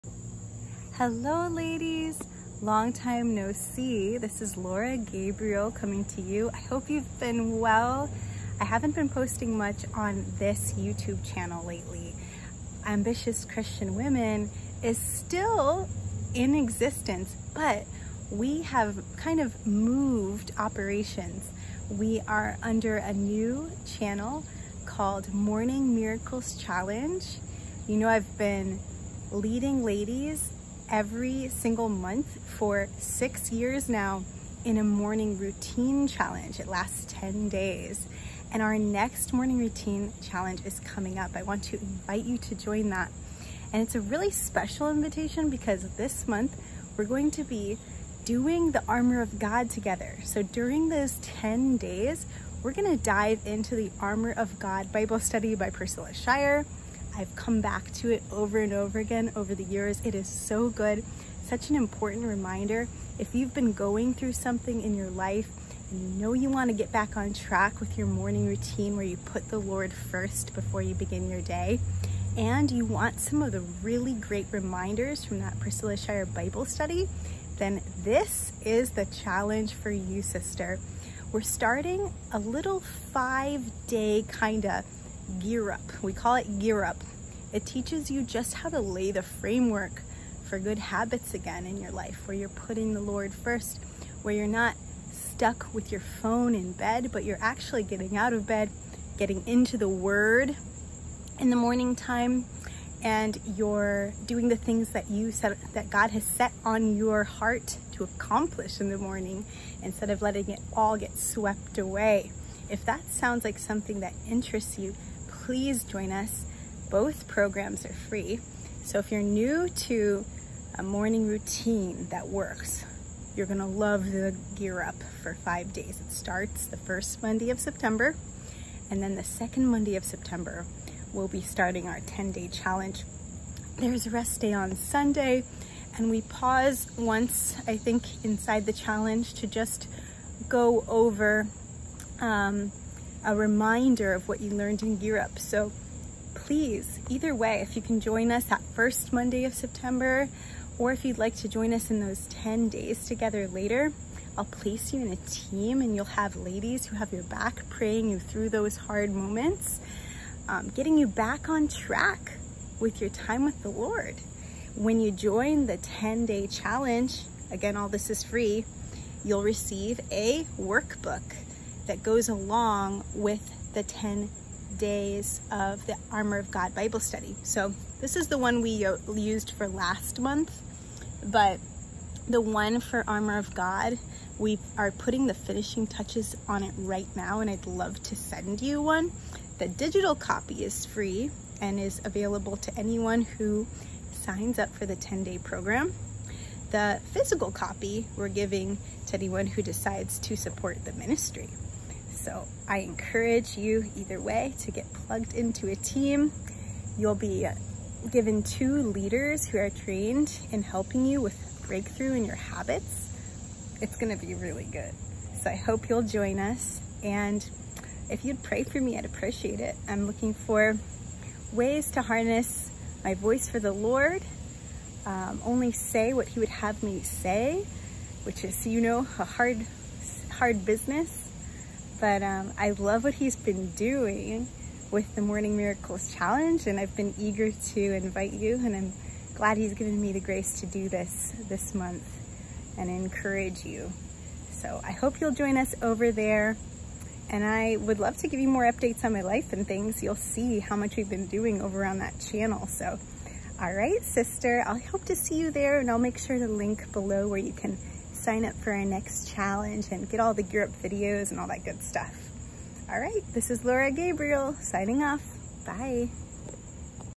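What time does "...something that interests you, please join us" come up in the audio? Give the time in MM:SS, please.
01:53.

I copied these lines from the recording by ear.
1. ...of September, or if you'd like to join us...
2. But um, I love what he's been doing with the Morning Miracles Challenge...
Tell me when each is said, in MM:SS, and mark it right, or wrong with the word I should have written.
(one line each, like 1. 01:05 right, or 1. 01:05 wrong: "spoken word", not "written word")
1. 02:29 right
2. 03:51 right.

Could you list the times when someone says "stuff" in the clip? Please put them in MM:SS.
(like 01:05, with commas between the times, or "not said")
04:21.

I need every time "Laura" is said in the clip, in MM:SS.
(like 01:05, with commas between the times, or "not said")
00:04, 04:23.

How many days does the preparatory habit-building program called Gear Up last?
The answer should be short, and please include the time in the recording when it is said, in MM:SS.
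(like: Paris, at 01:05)
5, at 01:22.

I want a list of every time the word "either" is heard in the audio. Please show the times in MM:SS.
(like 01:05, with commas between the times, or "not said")
02:27, 03:23.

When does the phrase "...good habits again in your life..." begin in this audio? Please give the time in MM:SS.
01:30.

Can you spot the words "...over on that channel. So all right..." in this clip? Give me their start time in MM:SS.
04:11.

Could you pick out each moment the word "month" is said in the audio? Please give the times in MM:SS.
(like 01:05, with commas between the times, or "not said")
00:31, 00:46, 03:00, 04:01.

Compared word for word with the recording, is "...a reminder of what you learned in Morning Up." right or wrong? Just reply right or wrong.
wrong.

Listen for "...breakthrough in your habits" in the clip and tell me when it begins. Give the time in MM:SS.
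03:31.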